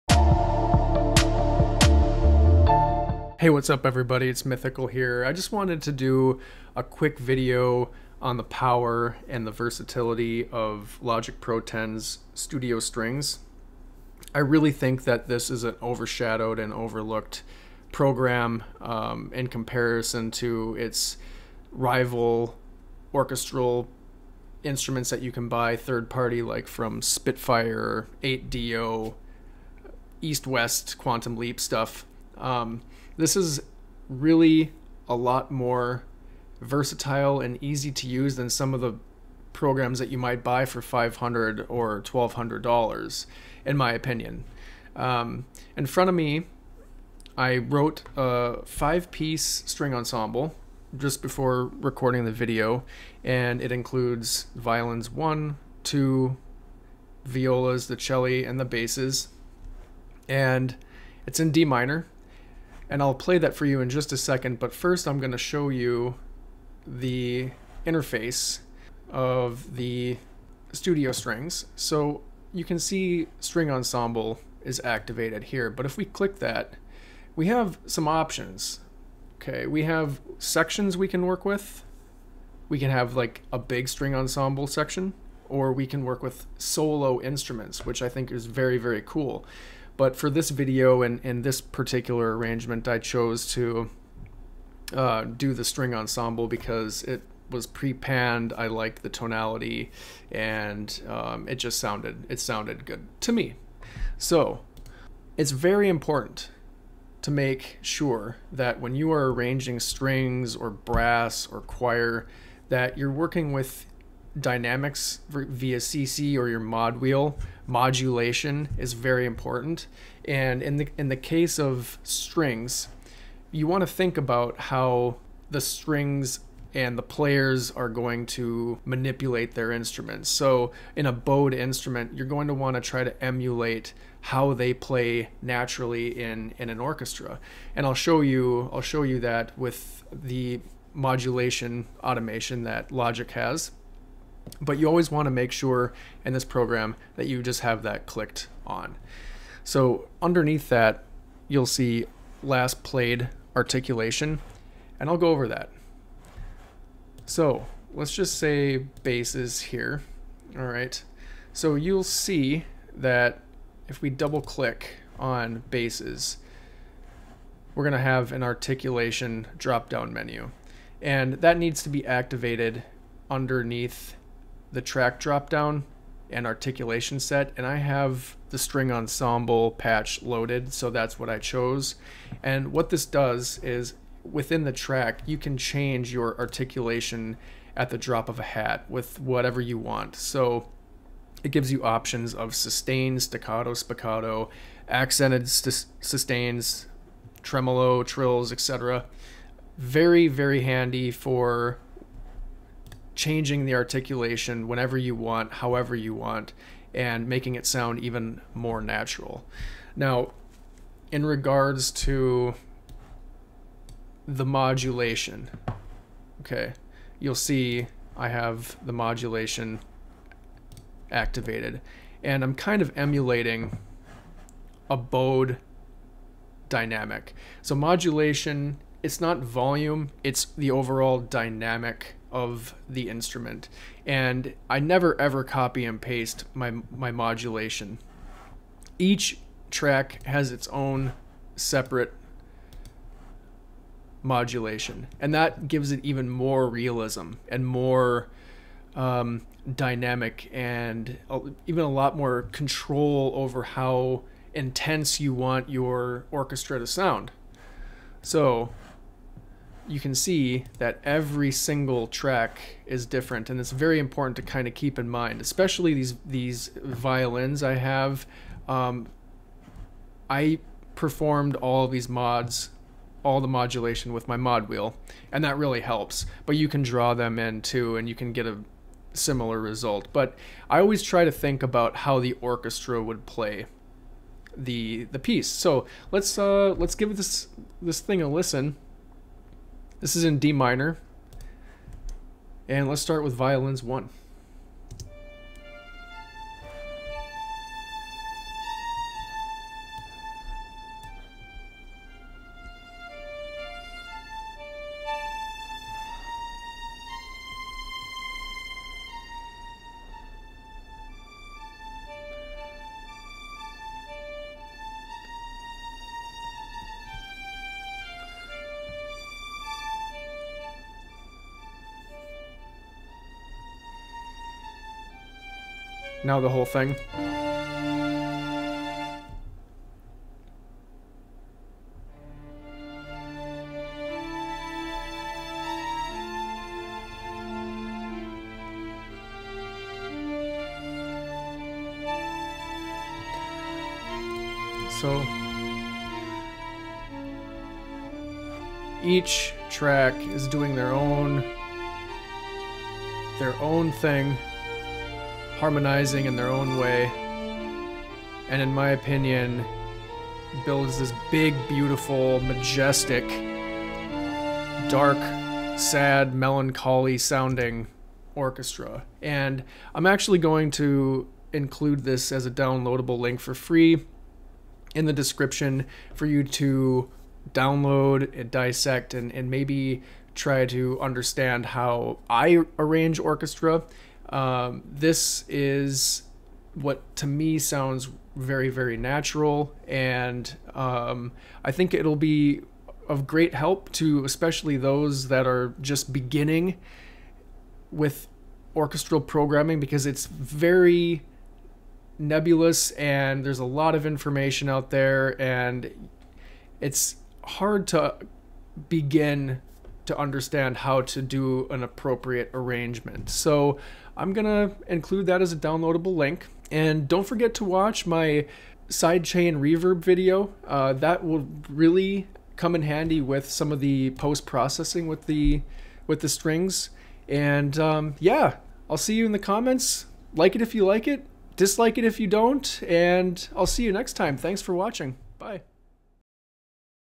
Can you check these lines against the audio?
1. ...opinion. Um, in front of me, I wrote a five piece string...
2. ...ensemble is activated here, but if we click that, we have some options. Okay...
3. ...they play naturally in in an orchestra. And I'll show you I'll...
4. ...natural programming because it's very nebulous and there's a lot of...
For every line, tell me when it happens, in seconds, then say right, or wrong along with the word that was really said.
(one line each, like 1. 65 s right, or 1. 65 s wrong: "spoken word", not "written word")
1. 43 s right
2. 73 s right
3. 134 s right
4. 398 s wrong: "orchestral", not "natural".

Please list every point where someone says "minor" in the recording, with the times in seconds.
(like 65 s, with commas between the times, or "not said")
61 s, 290 s.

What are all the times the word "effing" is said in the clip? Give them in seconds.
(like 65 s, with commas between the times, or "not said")
not said.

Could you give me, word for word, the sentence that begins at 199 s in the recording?
Very, very handy for changing the articulation whenever you want, however you want, and making it sound even more natural.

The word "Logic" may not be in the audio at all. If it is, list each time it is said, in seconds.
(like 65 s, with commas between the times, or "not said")
11 s, 142 s.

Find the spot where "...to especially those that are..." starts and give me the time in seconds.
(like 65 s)
393 s.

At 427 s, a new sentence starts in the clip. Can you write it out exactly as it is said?
And um, yeah, I'll see you in the comments.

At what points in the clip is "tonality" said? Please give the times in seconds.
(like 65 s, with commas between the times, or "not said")
99 s.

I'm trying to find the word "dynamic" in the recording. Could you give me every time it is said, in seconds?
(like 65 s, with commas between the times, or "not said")
114 s, 226 s, 231 s, 249 s.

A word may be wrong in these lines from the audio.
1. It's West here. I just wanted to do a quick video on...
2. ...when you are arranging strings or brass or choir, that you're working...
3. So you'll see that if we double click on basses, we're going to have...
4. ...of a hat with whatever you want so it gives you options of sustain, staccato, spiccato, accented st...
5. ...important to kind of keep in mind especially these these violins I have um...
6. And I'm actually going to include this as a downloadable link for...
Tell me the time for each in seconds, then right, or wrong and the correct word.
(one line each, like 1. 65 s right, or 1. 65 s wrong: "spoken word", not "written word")
1. 4 s wrong: "Mythical", not "West"
2. 108 s right
3. 161 s right
4. 188 s right
5. 263 s right
6. 369 s right.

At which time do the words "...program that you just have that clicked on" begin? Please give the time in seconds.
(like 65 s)
146 s.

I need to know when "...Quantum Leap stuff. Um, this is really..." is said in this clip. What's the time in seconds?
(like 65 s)
30 s.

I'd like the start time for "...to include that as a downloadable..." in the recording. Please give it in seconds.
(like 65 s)
414 s.